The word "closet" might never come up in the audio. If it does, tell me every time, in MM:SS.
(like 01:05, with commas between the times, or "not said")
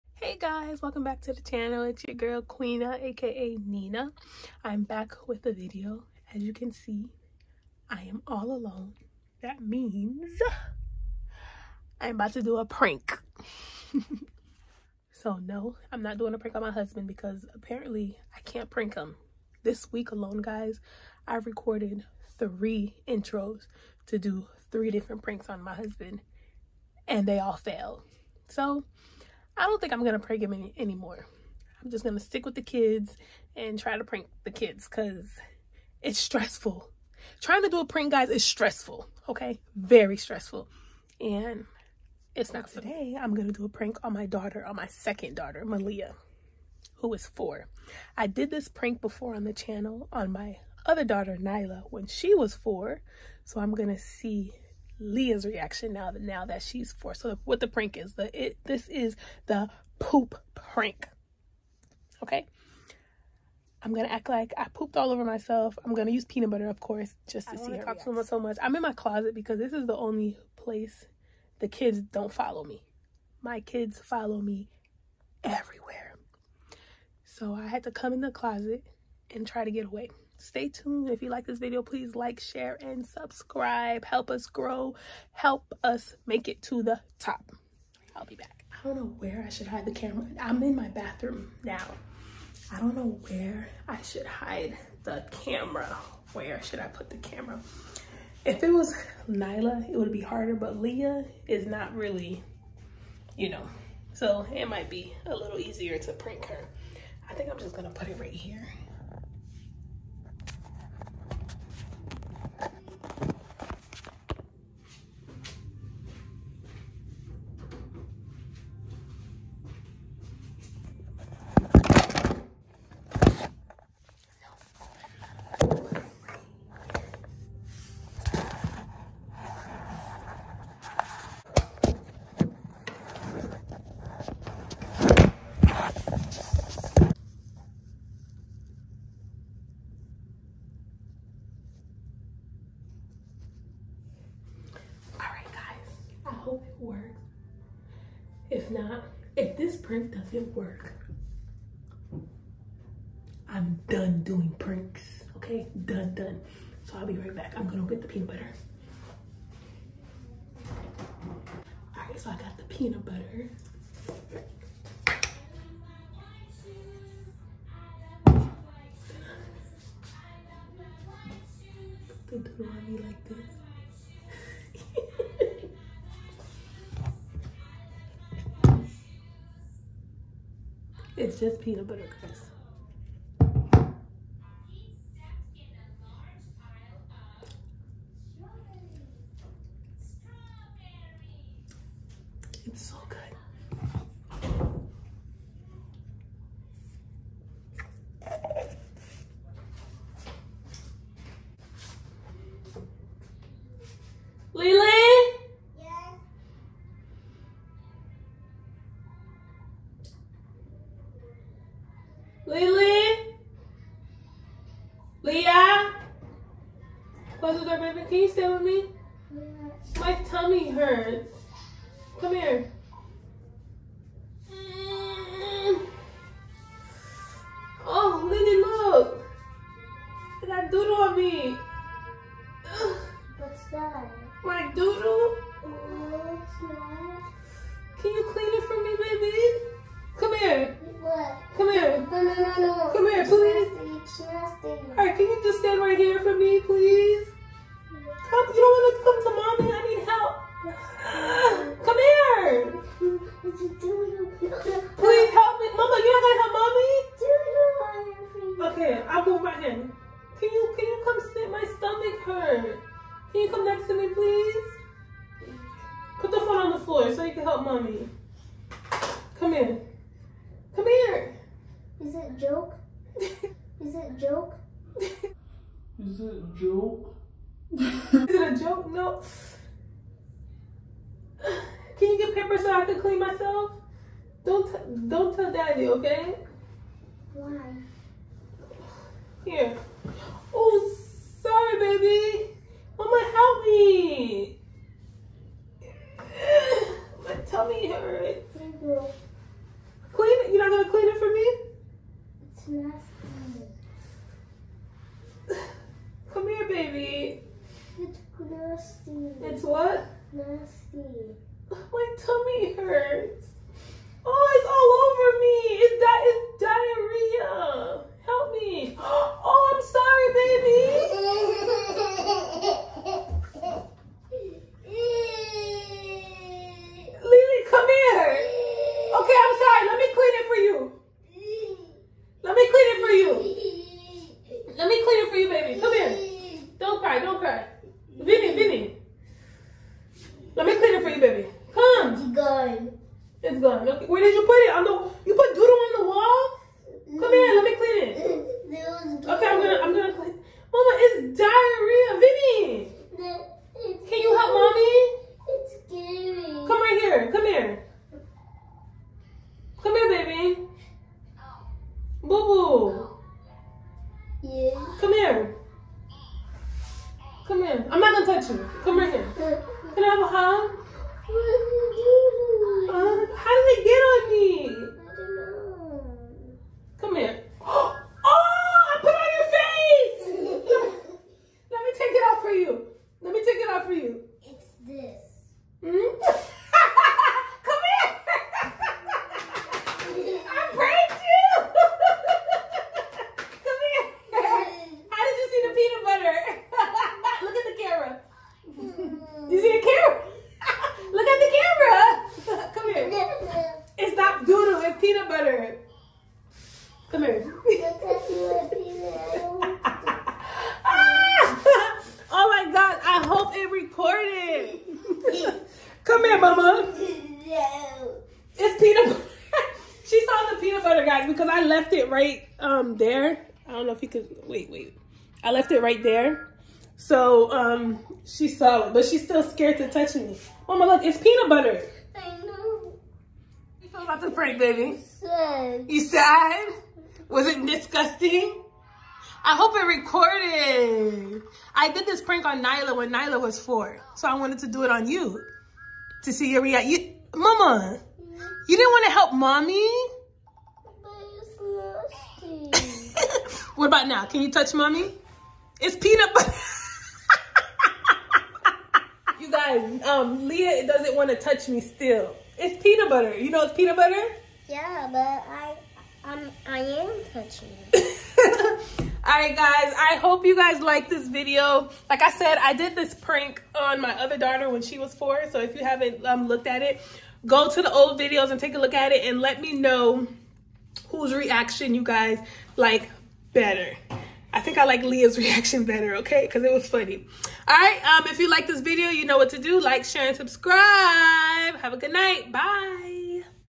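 01:08, 01:18.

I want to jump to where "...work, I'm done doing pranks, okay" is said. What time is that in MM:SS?
02:30.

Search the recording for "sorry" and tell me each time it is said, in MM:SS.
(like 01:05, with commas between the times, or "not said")
04:51, 05:19.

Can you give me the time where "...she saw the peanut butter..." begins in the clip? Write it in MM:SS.
07:00.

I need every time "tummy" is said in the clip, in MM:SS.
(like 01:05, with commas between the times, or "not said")
03:40, 04:57, 05:12.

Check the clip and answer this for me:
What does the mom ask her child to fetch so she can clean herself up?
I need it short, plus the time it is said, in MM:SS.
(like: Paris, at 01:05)
Paper, at 04:42.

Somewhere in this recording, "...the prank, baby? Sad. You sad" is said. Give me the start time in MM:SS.
07:14.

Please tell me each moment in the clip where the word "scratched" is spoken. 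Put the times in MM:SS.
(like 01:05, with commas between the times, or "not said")
not said.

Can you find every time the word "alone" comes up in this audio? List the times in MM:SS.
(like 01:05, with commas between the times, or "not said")
00:08, 00:20.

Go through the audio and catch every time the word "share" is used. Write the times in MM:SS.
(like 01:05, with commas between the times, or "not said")
01:22, 08:10.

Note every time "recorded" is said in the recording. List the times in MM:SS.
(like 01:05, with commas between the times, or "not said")
00:21, 07:19.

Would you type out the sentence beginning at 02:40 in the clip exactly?
All right, so I got the peanut butter.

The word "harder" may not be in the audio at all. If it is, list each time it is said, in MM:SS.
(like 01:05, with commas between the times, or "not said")
01:40.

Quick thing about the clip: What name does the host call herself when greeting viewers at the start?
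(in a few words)
Queena.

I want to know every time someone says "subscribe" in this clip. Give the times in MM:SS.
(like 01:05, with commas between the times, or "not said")
01:23, 08:10.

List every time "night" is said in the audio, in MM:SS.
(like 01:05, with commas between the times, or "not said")
08:12.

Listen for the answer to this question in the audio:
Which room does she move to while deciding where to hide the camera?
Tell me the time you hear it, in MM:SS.
01:30.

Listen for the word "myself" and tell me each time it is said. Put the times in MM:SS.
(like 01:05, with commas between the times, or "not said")
01:05, 04:43.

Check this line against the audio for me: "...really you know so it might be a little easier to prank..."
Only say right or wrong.
right.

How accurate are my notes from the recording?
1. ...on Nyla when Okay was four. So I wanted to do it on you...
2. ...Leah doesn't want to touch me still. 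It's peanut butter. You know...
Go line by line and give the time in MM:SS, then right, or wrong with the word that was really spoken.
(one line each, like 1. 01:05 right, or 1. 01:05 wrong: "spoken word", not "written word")
1. 07:22 wrong: "Nyla", not "Okay"
2. 07:40 right.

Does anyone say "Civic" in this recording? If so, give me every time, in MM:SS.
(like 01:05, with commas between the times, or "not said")
not said.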